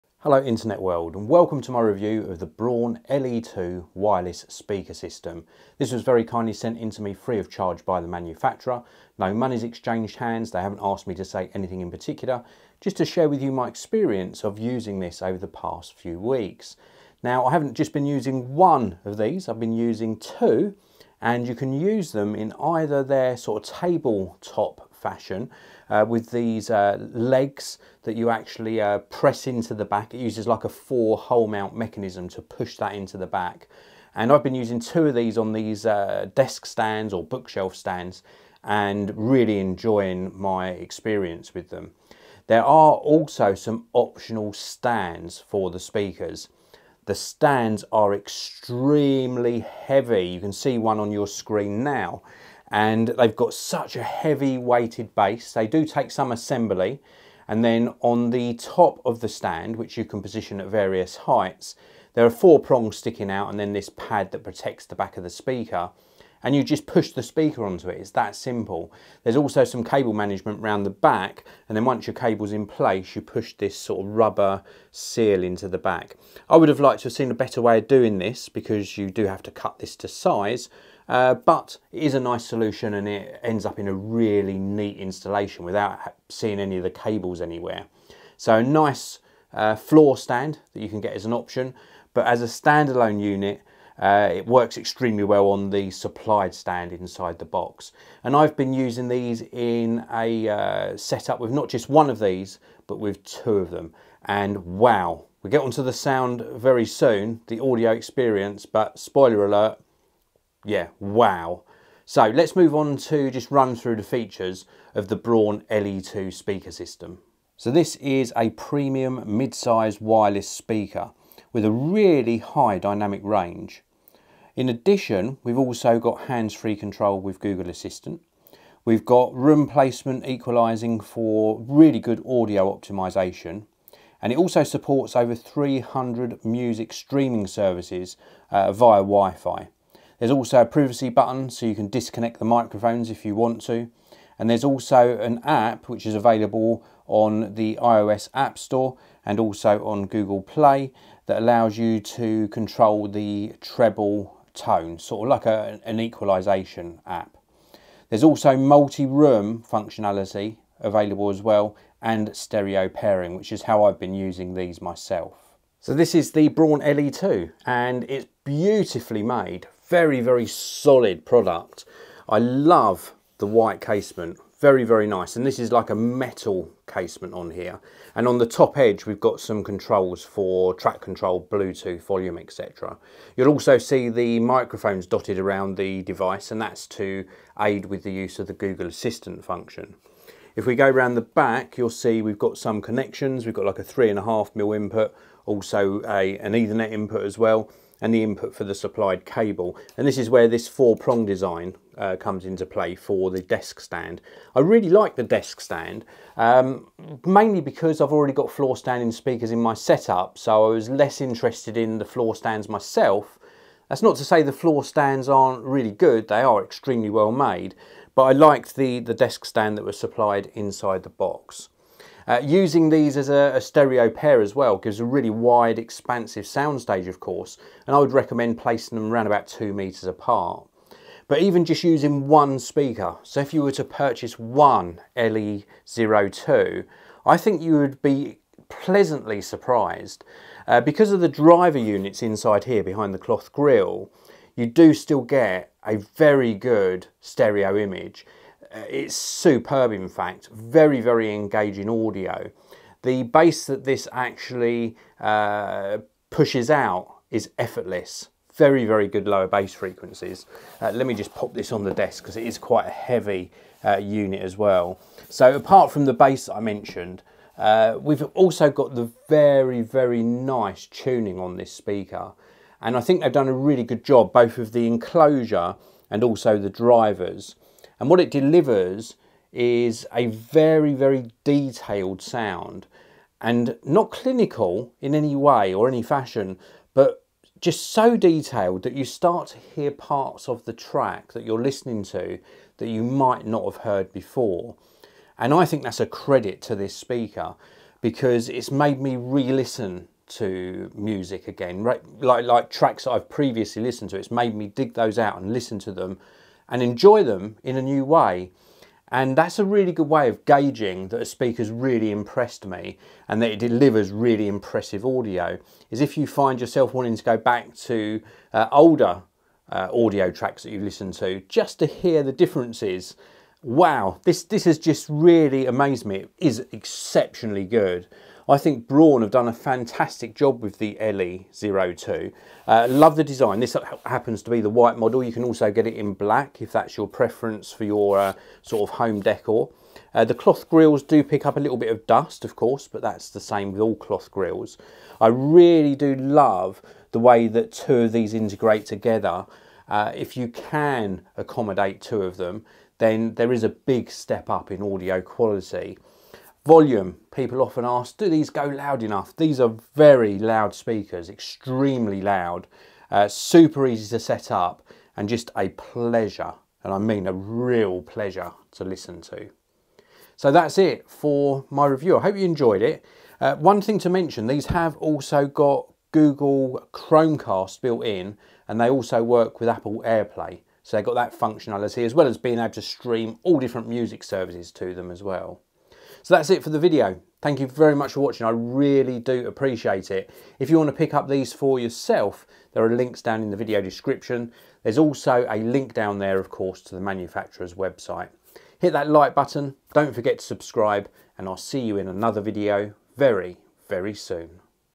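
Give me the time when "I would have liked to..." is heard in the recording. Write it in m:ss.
1:16.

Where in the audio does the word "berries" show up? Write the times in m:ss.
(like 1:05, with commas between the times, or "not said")
not said.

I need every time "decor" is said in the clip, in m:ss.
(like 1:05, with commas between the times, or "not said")
5:39.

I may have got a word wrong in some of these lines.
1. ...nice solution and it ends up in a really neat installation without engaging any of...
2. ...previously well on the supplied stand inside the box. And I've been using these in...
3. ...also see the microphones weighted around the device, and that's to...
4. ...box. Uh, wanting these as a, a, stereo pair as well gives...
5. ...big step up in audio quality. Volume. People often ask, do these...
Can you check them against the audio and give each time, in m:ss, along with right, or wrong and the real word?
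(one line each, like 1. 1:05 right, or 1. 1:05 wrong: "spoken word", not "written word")
1. 1:22 wrong: "seeing", not "engaging"
2. 1:34 wrong: "extremely", not "previously"
3. 3:03 wrong: "dotted", not "weighted"
4. 3:41 wrong: "using", not "wanting"
5. 5:53 right.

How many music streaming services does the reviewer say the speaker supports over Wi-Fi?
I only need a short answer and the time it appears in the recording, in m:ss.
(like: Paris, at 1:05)
over 300, at 2:15.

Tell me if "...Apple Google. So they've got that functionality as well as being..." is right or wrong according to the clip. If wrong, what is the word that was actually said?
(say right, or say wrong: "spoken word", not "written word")
wrong: "AirPlay", not "Google".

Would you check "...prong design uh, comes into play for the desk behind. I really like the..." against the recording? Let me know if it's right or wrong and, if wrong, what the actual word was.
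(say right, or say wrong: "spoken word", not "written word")
wrong: "stand", not "behind".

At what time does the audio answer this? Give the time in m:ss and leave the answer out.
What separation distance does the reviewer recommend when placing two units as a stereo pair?
3:49.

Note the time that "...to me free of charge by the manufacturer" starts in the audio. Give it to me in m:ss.
0:06.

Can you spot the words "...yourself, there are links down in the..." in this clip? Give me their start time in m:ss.
6:31.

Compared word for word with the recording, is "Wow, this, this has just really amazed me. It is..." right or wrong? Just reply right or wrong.
right.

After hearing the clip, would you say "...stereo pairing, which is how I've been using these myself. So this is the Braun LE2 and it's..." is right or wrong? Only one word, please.
right.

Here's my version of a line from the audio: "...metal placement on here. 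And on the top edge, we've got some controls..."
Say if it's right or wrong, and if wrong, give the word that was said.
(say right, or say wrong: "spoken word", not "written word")
wrong: "casement", not "placement".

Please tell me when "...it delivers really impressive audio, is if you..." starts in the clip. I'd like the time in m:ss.
5:13.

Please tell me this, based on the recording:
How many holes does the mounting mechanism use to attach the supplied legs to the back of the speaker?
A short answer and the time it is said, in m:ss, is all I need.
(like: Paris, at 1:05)
4, at 0:30.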